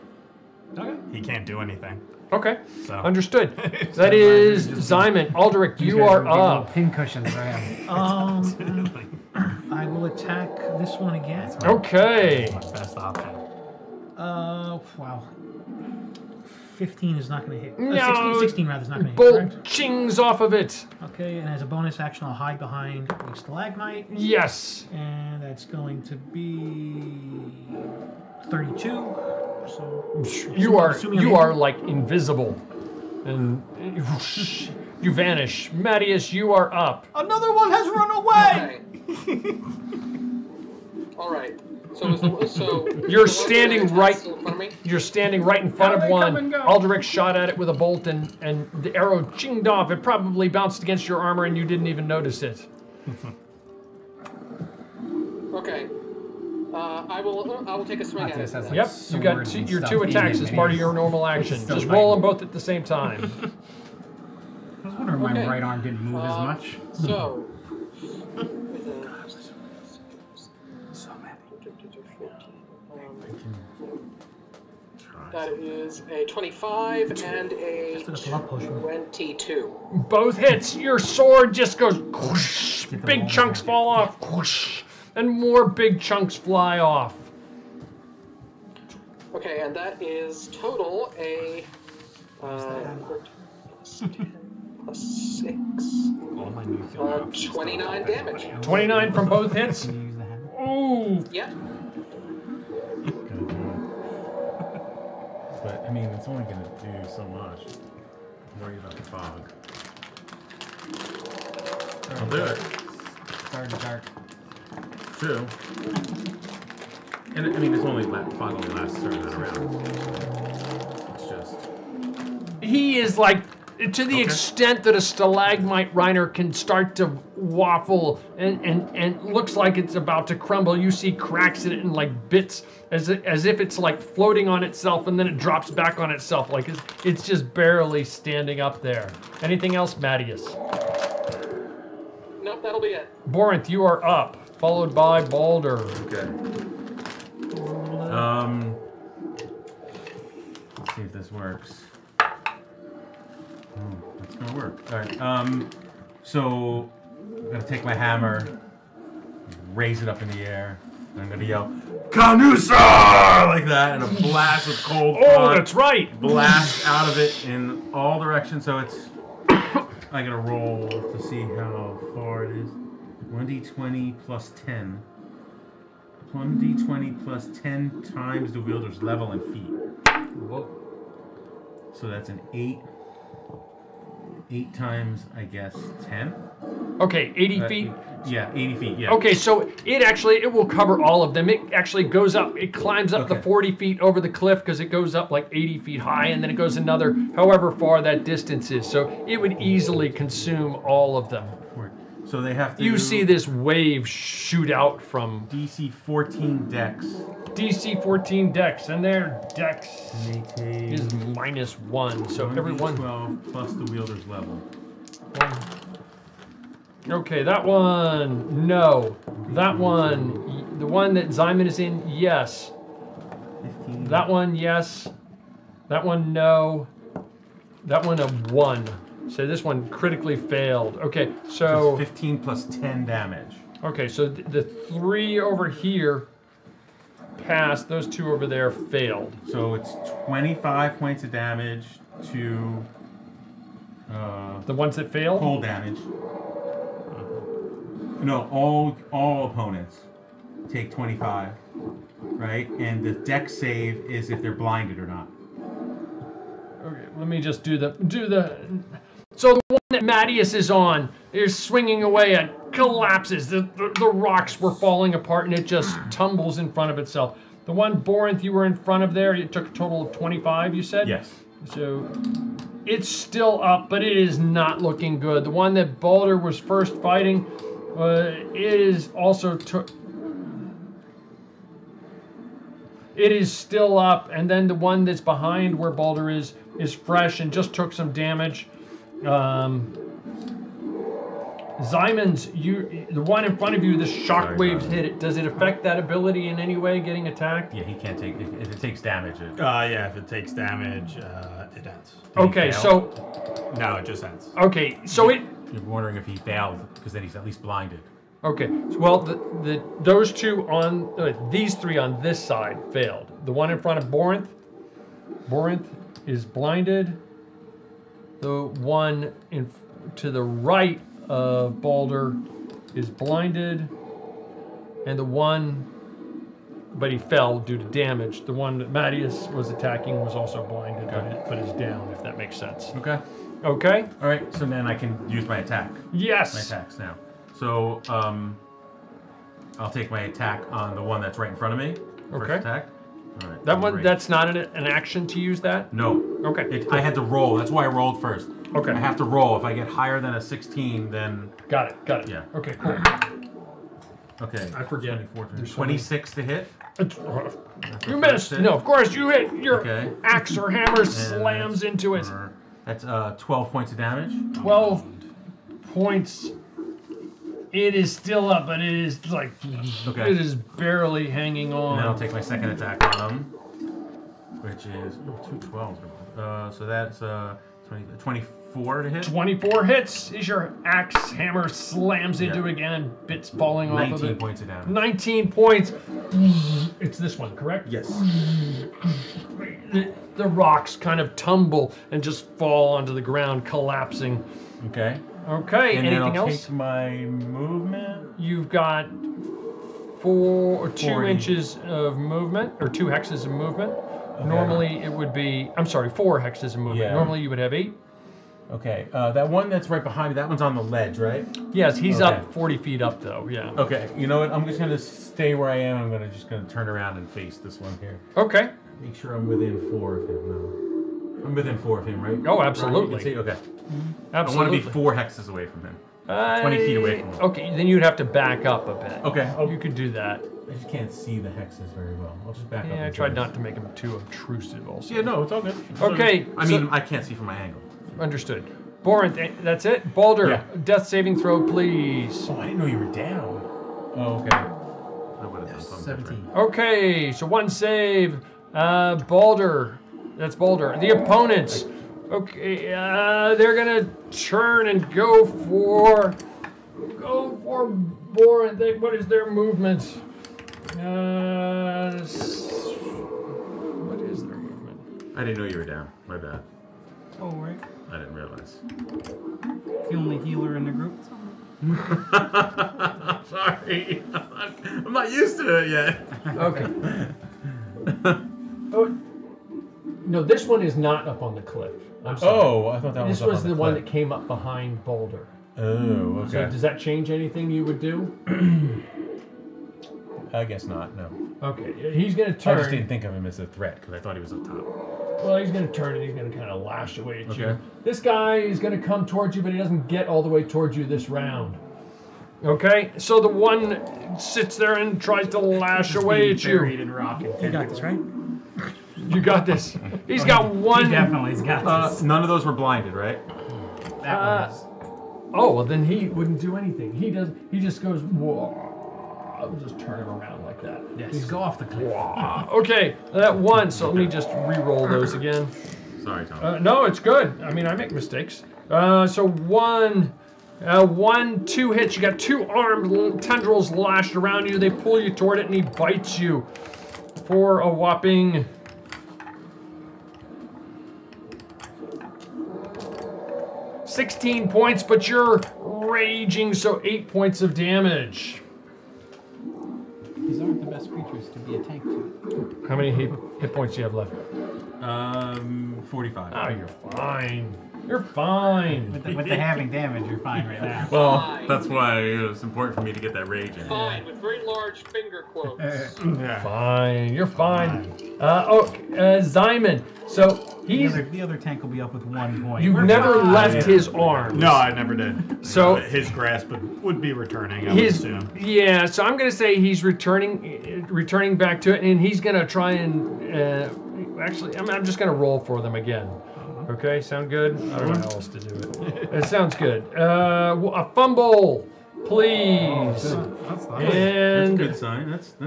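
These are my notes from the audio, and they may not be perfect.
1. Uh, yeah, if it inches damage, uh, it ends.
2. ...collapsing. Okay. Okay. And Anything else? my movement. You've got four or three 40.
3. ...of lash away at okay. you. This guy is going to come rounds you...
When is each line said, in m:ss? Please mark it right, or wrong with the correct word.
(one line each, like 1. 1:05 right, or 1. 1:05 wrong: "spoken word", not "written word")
1. 4:59 wrong: "takes", not "inches"
2. 6:33 wrong: "two", not "three"
3. 8:16 wrong: "towards", not "rounds".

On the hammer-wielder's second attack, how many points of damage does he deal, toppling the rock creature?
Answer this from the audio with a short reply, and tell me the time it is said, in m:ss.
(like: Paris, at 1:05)
19, at 6:24.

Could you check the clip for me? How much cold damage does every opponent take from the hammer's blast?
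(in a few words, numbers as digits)
25.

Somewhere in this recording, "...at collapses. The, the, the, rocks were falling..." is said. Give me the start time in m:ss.
4:22.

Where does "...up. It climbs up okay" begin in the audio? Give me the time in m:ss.
3:12.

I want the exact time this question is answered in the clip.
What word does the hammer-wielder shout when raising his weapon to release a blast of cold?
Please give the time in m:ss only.
2:42.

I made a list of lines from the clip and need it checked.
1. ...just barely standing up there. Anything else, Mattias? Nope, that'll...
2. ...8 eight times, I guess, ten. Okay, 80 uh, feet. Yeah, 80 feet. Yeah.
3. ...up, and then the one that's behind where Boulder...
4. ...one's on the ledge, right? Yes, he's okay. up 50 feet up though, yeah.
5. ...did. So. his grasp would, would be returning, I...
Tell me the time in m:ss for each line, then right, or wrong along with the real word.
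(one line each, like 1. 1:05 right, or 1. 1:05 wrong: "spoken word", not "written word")
1. 2:17 right
2. 3:02 right
3. 4:43 wrong: "Balder", not "Boulder"
4. 6:50 wrong: "40", not "50"
5. 9:35 right.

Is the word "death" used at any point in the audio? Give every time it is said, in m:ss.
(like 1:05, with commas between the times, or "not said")
7:20.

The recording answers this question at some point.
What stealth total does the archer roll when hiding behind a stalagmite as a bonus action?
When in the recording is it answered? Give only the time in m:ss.
0:25.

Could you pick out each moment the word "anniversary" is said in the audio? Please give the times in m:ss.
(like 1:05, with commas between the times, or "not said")
not said.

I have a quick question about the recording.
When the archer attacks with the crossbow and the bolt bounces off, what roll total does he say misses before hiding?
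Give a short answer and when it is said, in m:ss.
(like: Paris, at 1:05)
16, at 0:18.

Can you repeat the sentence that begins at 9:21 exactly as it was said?
Well, that's why it was important for me to get that rage in.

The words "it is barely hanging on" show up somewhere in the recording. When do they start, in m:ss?
6:10.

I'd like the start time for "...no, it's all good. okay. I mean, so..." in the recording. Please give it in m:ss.
7:15.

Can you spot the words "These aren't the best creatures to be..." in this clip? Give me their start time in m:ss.
9:10.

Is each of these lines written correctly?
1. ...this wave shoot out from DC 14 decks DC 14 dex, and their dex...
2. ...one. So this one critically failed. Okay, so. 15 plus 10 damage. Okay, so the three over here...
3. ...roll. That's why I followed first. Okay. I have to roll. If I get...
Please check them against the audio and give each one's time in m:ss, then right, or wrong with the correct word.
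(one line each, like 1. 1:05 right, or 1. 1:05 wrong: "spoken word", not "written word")
1. 3:23 right
2. 3:48 right
3. 5:47 wrong: "rolled", not "followed".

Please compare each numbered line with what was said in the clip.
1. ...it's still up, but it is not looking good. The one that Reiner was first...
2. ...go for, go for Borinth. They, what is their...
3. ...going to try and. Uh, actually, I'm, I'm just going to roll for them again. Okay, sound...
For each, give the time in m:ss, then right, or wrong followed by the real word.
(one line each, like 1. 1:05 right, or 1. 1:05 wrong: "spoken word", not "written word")
1. 4:32 wrong: "Balder", not "Reiner"
2. 7:35 right
3. 9:42 right.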